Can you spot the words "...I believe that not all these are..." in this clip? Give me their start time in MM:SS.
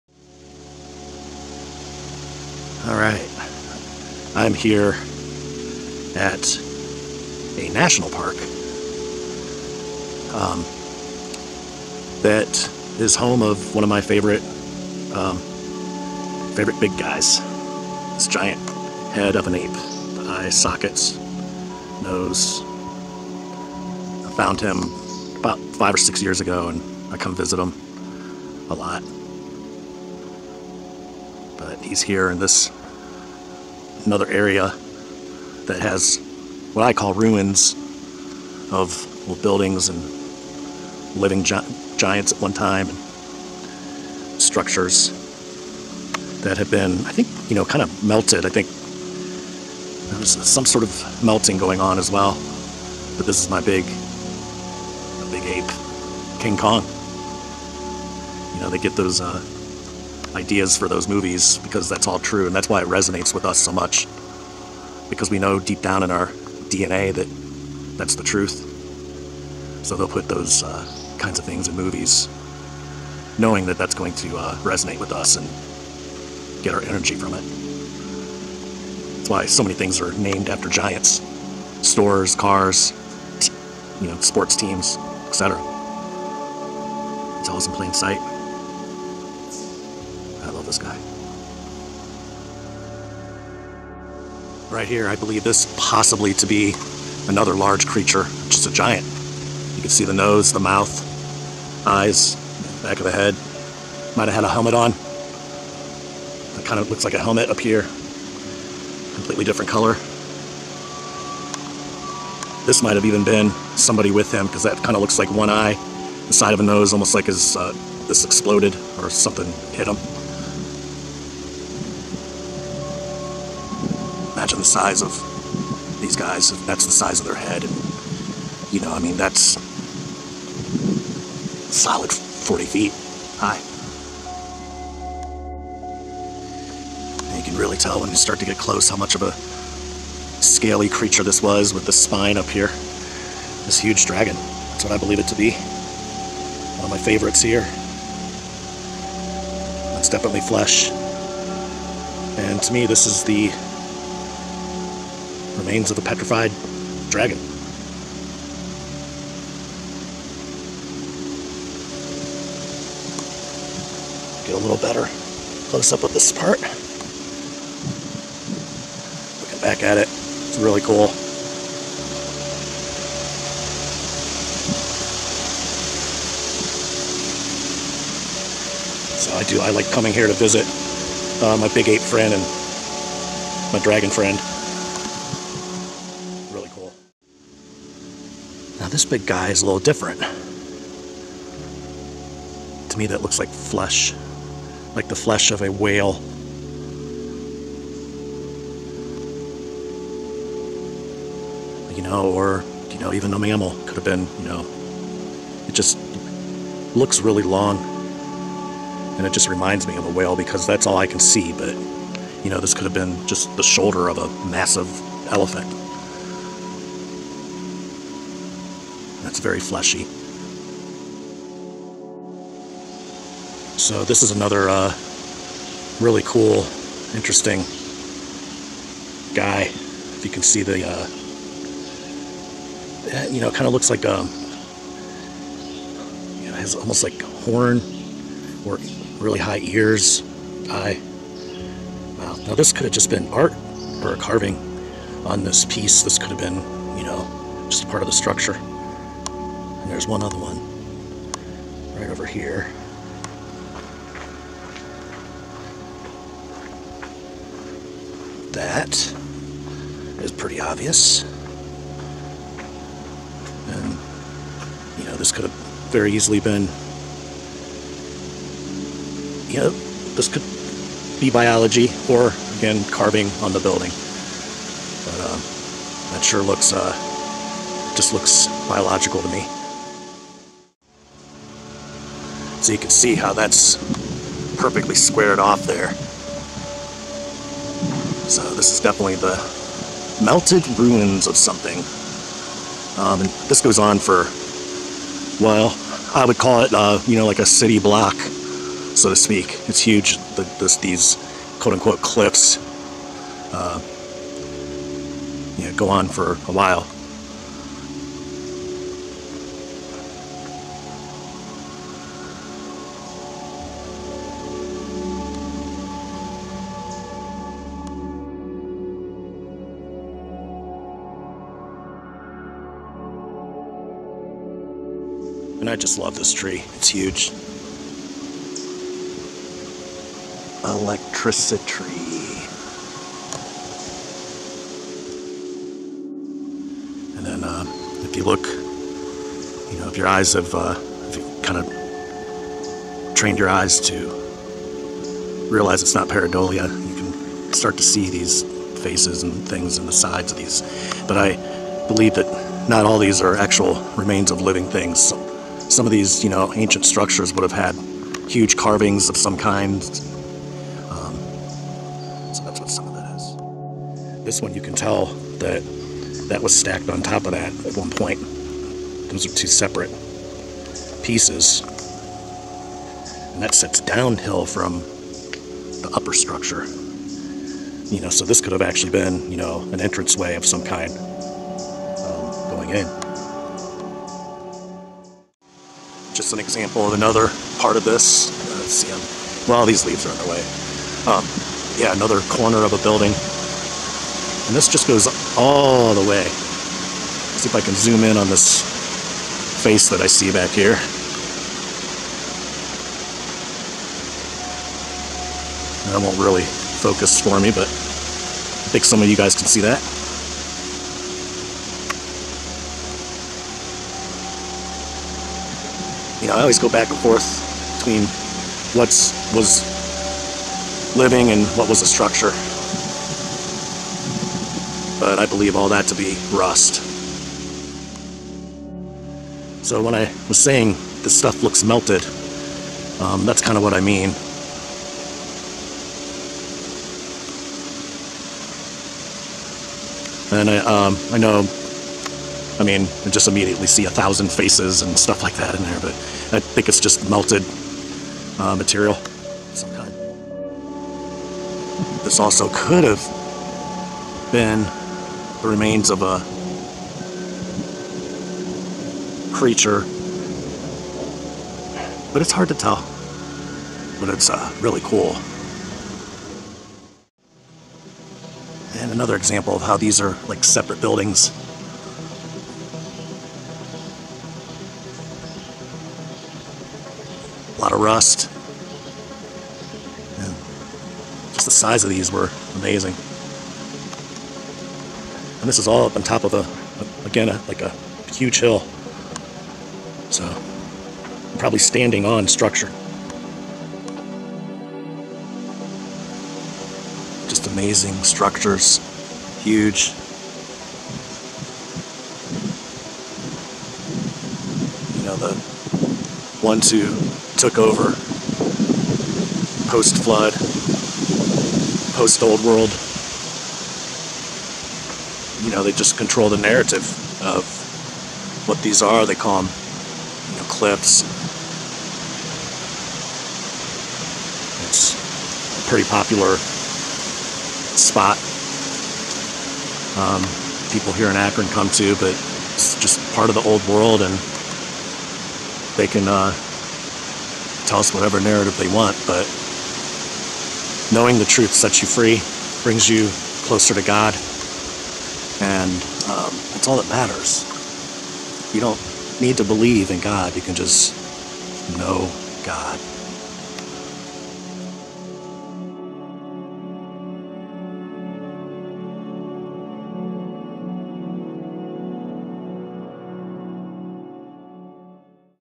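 05:51.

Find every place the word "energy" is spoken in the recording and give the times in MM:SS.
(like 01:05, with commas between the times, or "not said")
01:16.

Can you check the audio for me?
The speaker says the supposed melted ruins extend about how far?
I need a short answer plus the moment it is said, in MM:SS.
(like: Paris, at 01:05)
A city block, at 04:57.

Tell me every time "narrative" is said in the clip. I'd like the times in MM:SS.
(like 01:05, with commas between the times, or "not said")
08:36, 08:58.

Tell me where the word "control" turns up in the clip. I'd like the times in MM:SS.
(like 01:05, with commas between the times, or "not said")
08:35.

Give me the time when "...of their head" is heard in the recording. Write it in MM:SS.
02:07.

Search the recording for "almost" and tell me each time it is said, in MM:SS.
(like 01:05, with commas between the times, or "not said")
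01:56, 03:56.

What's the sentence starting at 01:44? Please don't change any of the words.
Might have had a helmet on.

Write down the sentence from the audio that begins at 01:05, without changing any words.
Because we know deep down in our DNA that that's the truth.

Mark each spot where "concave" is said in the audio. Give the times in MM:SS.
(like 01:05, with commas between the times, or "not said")
not said.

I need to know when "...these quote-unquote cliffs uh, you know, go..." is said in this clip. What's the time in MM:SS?
05:00.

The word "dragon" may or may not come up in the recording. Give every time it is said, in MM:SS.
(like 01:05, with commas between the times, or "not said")
02:24, 02:37, 03:03.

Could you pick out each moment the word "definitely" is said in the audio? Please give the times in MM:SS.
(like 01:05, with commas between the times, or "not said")
02:30, 04:48.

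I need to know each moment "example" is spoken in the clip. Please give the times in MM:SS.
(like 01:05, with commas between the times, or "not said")
06:26, 07:49.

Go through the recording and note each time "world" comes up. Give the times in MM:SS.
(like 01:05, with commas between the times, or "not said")
08:32, 08:53.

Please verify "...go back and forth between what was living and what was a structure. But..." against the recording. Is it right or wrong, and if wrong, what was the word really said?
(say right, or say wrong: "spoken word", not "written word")
right.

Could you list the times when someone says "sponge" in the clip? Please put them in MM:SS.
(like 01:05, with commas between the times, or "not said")
not said.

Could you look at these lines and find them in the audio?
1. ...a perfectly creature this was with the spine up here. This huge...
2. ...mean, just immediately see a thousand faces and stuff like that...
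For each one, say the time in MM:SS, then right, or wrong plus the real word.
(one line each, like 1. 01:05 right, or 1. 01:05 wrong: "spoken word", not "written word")
1. 02:19 wrong: "scaly", not "perfectly"
2. 07:22 right.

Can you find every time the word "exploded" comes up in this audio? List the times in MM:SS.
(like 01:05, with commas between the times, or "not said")
01:58.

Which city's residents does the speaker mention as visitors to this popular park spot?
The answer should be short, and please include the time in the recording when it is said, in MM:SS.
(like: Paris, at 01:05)
Akron, at 08:51.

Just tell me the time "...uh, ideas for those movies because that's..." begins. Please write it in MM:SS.
00:59.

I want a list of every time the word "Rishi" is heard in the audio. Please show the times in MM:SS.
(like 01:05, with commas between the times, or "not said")
not said.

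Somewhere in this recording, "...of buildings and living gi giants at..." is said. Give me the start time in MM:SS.
00:38.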